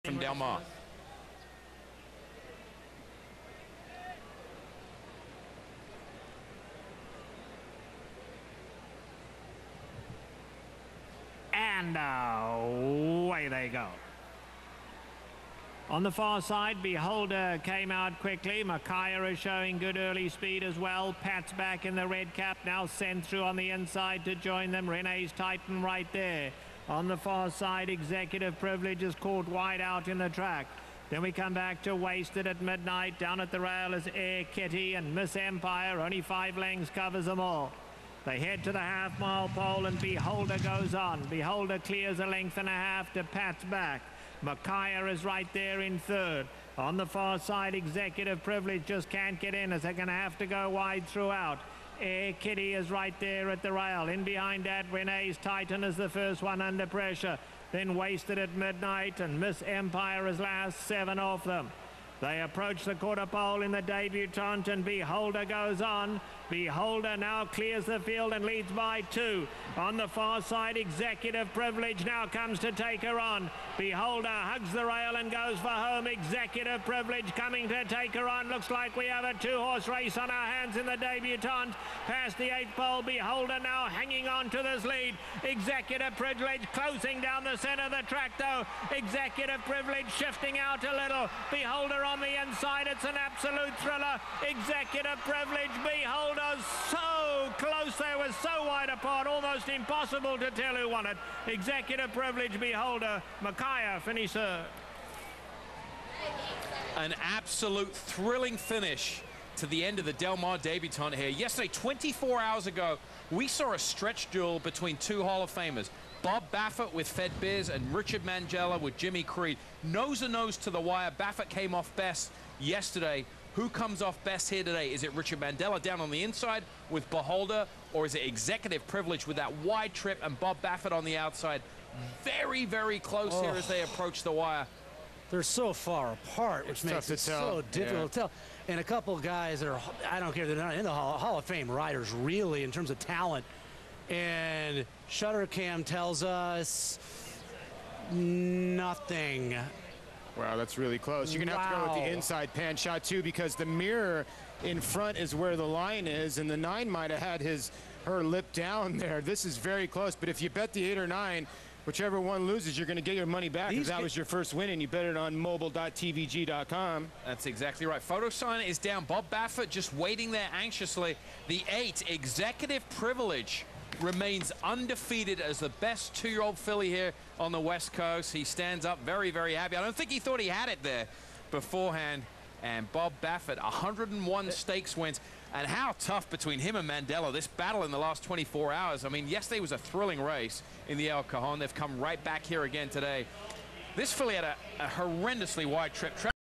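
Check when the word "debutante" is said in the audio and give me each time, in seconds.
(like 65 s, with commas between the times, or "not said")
63 s, 80 s, 110 s.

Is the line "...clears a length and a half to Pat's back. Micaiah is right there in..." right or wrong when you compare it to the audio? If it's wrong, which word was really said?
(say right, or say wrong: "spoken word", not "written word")
right.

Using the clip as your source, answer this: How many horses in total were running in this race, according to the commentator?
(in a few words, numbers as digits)
7.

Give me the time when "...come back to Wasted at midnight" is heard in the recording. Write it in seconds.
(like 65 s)
31 s.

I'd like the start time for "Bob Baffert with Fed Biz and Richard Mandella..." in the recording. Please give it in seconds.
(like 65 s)
116 s.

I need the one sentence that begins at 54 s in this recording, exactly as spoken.
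In behind that, Renee's Titan is the first one under pressure.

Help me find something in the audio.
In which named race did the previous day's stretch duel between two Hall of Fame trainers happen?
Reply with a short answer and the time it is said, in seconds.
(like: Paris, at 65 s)
El Cajon, at 191 s.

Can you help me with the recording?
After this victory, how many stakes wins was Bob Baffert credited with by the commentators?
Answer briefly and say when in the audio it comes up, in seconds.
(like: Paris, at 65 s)
101, at 183 s.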